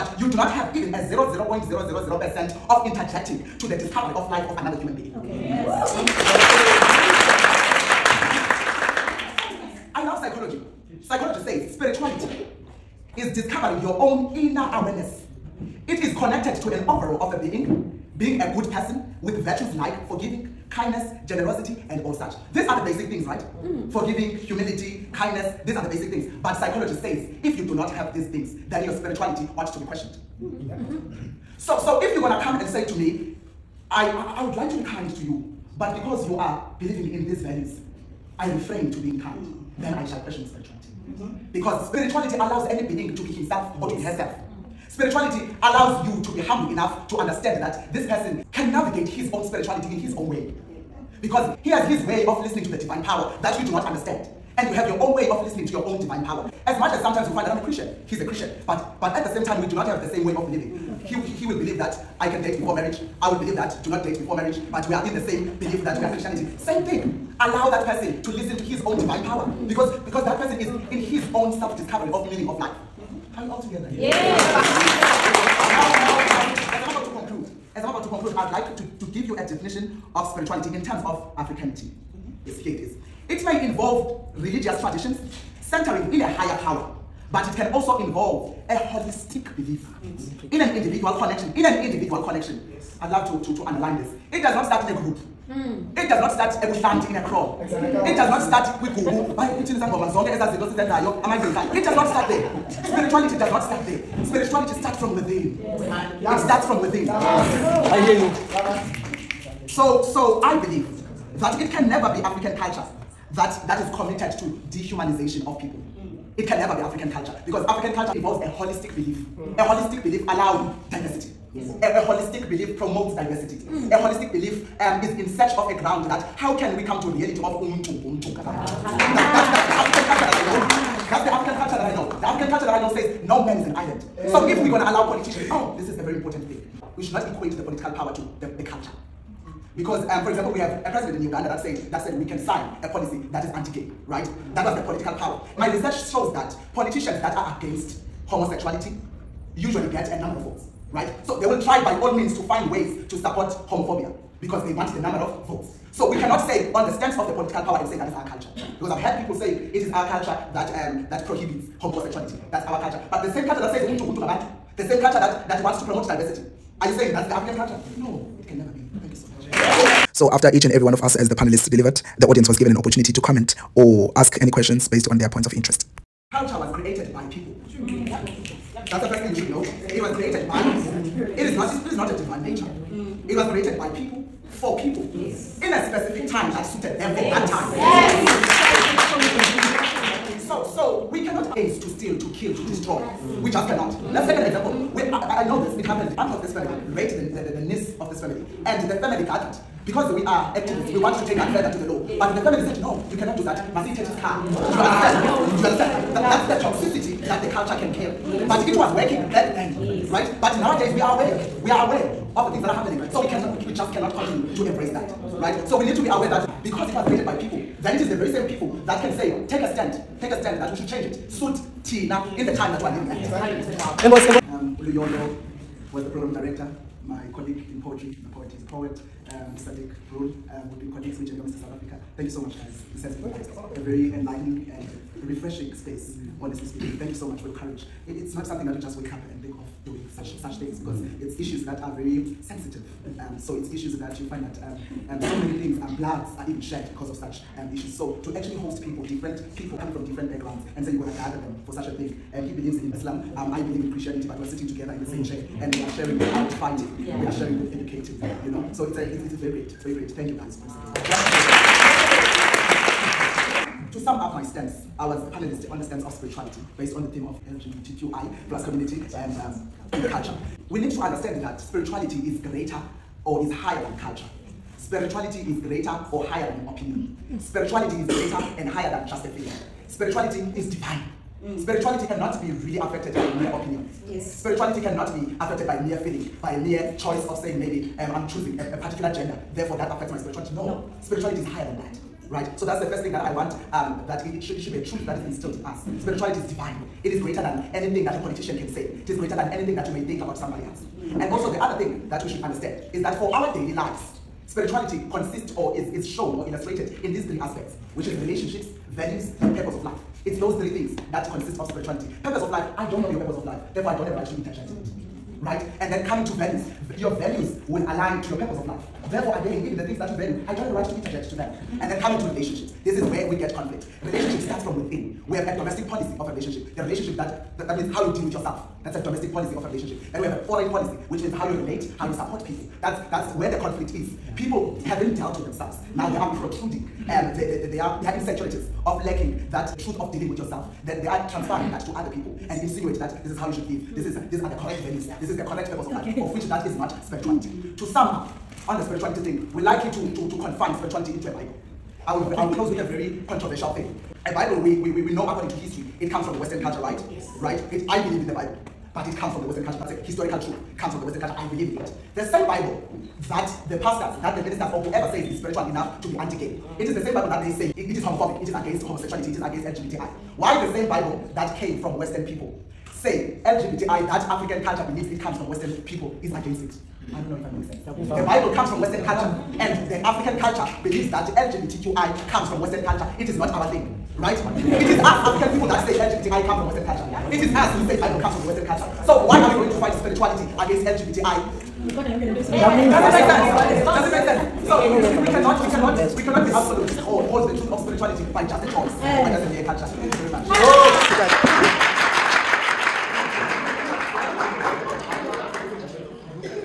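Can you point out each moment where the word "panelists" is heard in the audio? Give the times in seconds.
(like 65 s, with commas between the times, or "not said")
171 s, 265 s.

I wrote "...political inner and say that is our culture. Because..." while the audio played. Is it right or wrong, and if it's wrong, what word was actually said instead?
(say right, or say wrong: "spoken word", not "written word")
wrong: "power", not "inner".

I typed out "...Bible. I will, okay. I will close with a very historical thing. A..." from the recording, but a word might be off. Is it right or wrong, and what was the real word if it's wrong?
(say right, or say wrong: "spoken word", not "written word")
wrong: "controversial", not "historical".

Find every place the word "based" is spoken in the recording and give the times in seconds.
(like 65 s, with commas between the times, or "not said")
174 s, 266 s.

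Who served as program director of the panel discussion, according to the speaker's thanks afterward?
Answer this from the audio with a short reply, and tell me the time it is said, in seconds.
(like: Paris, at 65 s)
Luyolo, at 224 s.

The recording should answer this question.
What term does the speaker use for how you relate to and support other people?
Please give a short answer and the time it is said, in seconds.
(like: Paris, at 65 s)
foreign policy, at 330 s.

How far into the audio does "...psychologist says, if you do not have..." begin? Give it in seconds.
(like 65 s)
26 s.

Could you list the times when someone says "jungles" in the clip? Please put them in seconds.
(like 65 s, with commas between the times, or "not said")
not said.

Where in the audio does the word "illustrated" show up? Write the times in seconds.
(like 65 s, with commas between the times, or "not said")
306 s.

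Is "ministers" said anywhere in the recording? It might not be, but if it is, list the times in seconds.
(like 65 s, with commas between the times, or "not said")
364 s.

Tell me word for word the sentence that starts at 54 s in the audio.
And you have your own way of listening to your own divine power.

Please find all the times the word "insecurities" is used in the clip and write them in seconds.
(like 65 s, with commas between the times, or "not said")
338 s.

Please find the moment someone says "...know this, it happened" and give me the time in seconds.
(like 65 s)
195 s.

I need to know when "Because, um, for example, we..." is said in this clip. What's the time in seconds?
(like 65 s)
139 s.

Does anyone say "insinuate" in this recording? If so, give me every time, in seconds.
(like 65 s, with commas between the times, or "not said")
342 s.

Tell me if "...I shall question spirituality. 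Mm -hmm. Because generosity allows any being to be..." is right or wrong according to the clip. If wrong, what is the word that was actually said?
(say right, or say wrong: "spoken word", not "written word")
wrong: "spirituality", not "generosity".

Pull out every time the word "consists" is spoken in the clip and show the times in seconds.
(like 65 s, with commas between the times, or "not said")
305 s, 311 s.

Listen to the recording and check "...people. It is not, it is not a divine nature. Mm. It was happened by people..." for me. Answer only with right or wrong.
wrong.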